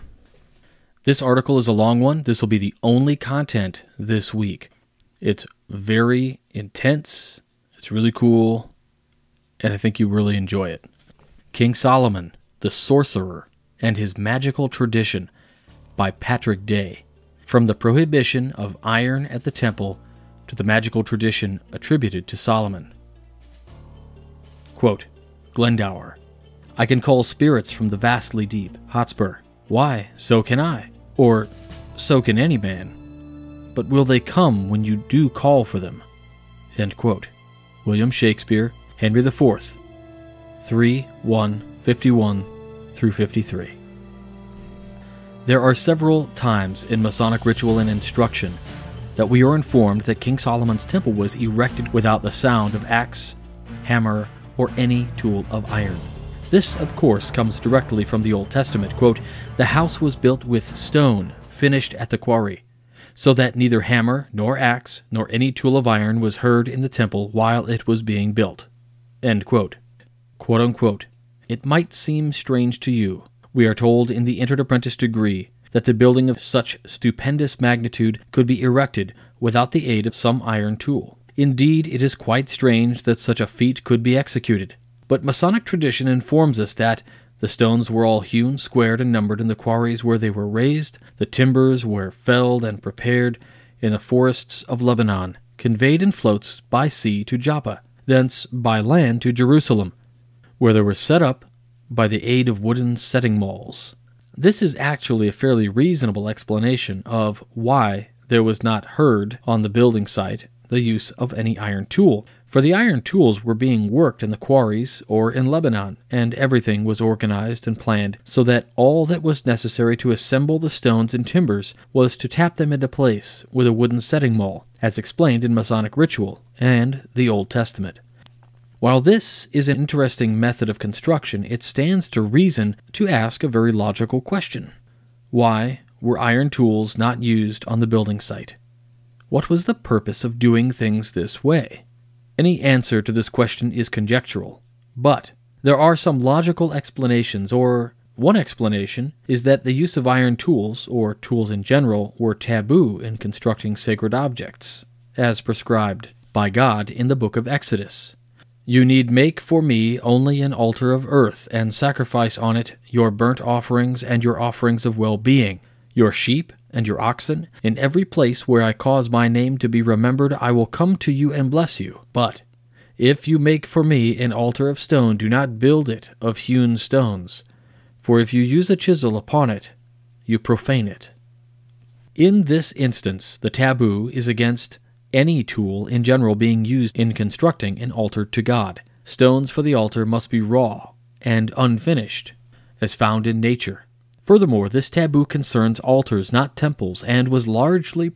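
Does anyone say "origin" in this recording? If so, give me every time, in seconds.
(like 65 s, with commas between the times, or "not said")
not said.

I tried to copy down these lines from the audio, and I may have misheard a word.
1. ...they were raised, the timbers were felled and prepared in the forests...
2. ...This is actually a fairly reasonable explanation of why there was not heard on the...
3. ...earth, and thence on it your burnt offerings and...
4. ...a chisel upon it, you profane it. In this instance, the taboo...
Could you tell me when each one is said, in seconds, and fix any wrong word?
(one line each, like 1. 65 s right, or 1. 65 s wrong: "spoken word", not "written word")
1. 90 s right
2. 104 s right
3. 161 s wrong: "sacrifice", not "thence"
4. 178 s right.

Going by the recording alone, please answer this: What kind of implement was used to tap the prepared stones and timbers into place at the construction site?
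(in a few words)
wooden setting maul.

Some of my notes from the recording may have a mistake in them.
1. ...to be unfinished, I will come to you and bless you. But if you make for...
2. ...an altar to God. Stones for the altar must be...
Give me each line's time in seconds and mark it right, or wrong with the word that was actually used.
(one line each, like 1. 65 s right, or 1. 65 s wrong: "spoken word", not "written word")
1. 169 s wrong: "remembered", not "unfinished"
2. 187 s right.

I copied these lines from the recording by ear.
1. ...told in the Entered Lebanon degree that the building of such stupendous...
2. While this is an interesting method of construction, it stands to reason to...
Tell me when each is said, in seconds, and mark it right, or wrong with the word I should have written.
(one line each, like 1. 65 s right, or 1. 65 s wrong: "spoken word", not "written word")
1. 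73 s wrong: "Apprentice", not "Lebanon"
2. 128 s right.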